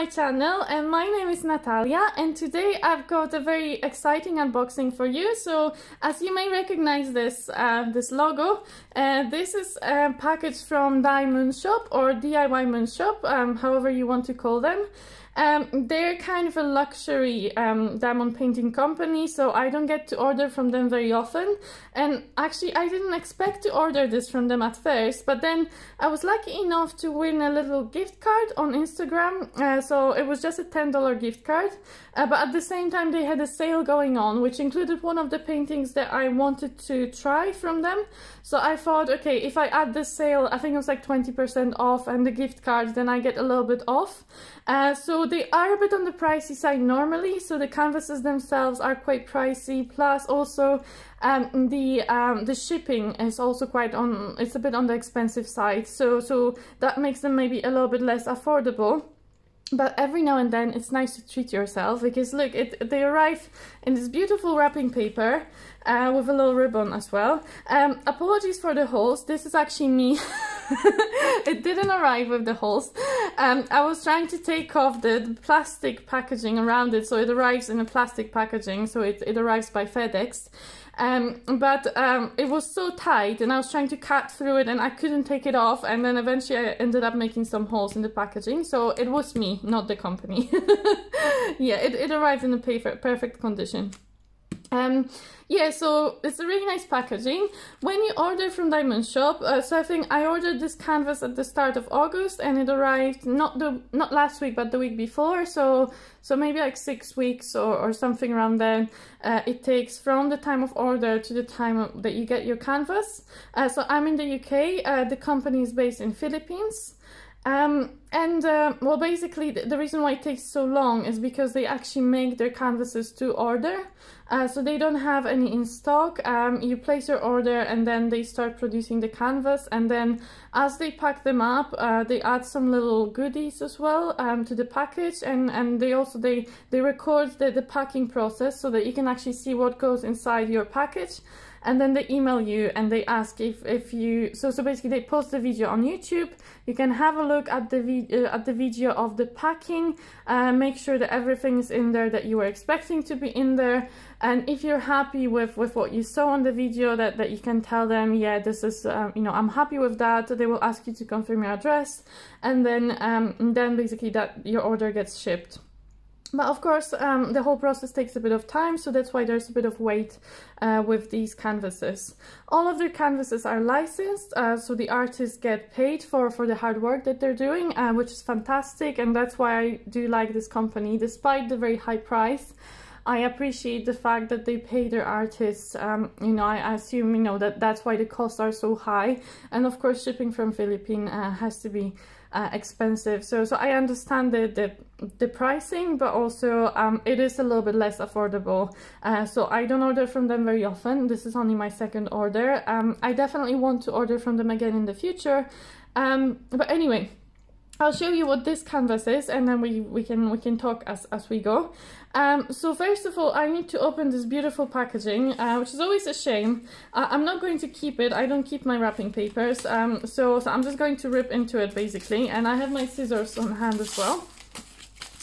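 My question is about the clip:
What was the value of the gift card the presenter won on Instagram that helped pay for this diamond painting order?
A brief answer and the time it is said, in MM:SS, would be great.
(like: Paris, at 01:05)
$10, at 00:30.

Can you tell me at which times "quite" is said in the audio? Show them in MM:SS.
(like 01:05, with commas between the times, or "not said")
00:48, 00:53.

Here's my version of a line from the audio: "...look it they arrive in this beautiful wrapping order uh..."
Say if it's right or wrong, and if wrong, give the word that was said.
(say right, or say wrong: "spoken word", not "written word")
wrong: "paper", not "order".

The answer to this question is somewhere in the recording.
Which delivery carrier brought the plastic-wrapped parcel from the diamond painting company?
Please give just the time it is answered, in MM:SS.
01:19.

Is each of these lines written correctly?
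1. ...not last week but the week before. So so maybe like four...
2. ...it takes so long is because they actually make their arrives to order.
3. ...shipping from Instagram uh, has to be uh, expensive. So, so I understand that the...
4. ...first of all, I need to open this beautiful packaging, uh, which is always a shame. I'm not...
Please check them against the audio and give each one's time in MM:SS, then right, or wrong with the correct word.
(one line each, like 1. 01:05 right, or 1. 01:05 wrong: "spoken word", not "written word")
1. 01:43 wrong: "six", not "four"
2. 02:00 wrong: "canvases", not "arrives"
3. 03:10 wrong: "Philippines", not "Instagram"
4. 03:32 right.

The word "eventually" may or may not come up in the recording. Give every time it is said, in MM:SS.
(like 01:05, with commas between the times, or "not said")
01:26.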